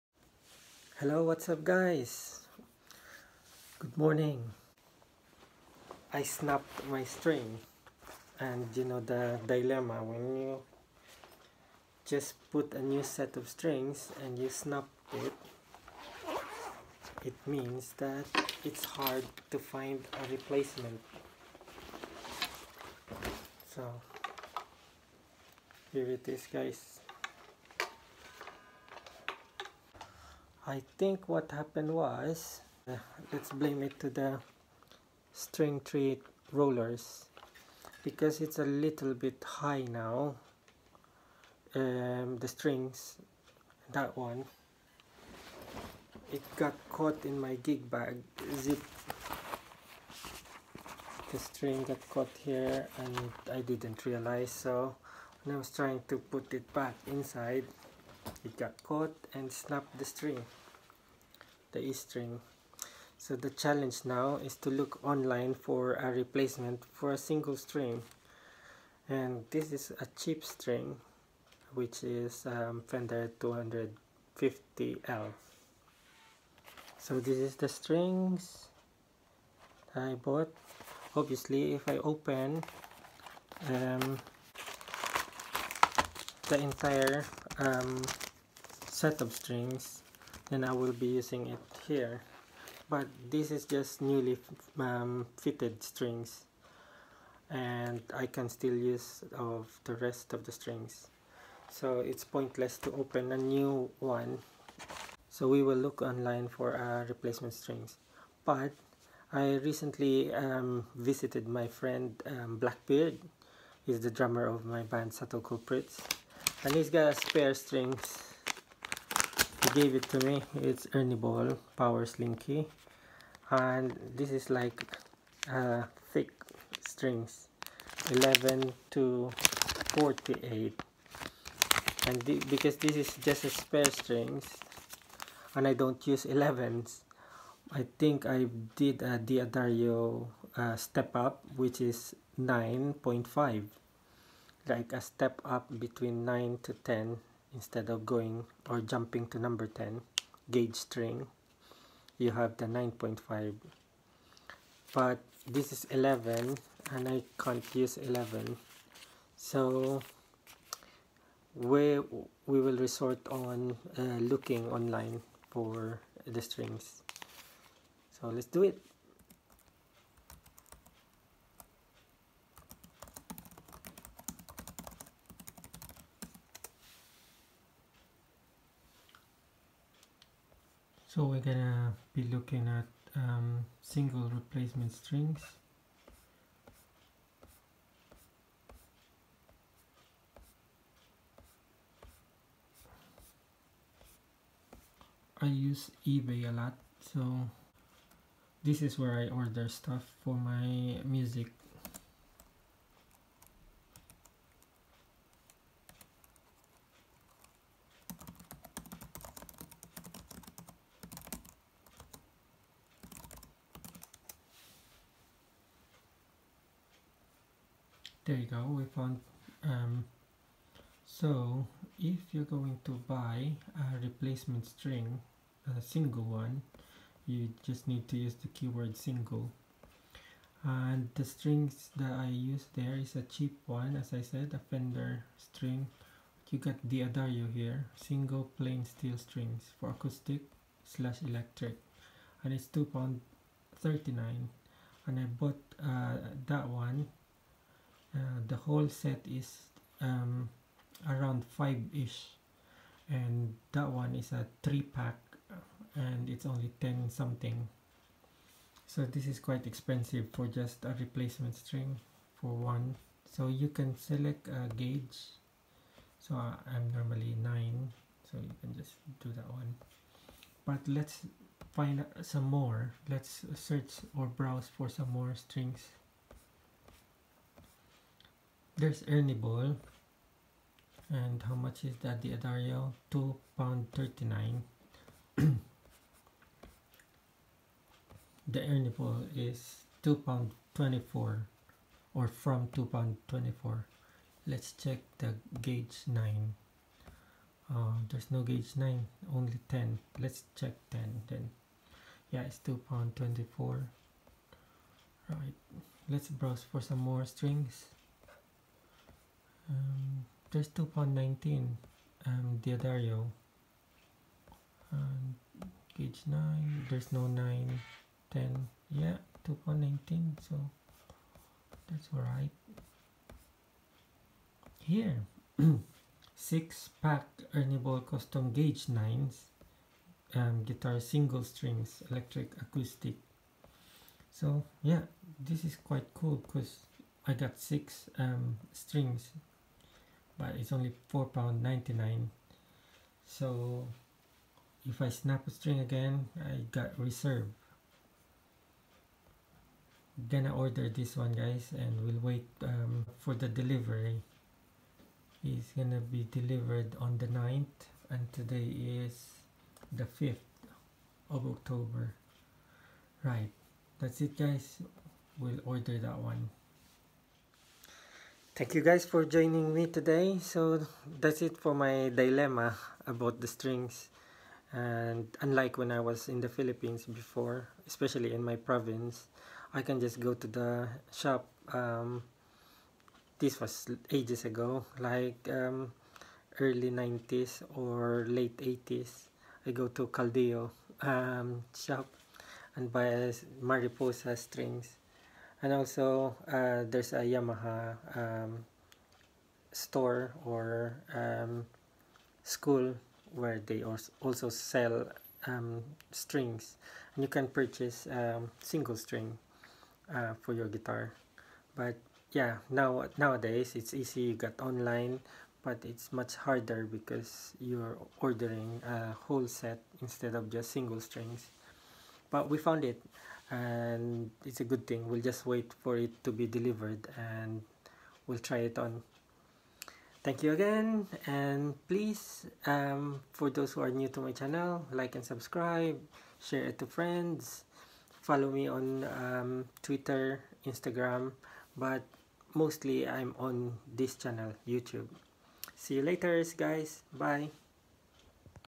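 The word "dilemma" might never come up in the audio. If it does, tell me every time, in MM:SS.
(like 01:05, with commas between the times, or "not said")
00:09, 06:12.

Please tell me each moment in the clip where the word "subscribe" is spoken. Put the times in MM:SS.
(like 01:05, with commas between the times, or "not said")
07:15.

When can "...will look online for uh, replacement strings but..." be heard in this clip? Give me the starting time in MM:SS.
01:45.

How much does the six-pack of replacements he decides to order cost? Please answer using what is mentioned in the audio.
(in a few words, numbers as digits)
£4.99.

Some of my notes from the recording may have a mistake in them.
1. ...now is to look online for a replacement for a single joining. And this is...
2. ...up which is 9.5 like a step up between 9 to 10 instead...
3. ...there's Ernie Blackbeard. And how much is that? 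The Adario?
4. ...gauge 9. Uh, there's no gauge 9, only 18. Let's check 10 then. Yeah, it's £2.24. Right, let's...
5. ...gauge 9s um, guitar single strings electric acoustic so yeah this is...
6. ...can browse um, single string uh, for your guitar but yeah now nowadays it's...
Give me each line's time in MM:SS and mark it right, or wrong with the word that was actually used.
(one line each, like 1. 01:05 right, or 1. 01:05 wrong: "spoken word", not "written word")
1. 01:04 wrong: "string", not "joining"
2. 02:21 right
3. 04:38 wrong: "Ball", not "Blackbeard"
4. 04:55 wrong: "10", not "18"
5. 05:28 right
6. 06:47 wrong: "purchase", not "browse".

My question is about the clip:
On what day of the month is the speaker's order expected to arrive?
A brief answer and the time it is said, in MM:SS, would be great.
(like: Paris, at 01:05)
9th, at 05:57.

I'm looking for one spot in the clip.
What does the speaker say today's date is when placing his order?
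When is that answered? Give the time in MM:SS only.
06:00.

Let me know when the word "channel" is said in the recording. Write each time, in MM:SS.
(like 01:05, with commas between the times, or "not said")
07:14, 07:24.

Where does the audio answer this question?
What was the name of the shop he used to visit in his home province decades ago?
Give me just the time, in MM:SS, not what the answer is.
06:30.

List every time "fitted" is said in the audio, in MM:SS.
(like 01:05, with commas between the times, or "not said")
01:35.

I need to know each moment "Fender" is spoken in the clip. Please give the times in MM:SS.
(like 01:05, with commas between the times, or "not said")
01:12, 03:54.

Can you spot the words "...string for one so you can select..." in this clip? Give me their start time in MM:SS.
04:21.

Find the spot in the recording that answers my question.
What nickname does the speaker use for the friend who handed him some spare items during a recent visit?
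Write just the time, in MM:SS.
01:52.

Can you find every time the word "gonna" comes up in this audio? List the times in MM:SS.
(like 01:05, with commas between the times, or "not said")
03:01, 05:50, 05:55.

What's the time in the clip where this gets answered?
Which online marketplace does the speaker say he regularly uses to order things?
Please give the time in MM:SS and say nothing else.
03:16.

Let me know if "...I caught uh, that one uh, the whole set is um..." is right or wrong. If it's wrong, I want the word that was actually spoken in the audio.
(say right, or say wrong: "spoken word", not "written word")
wrong: "bought", not "caught".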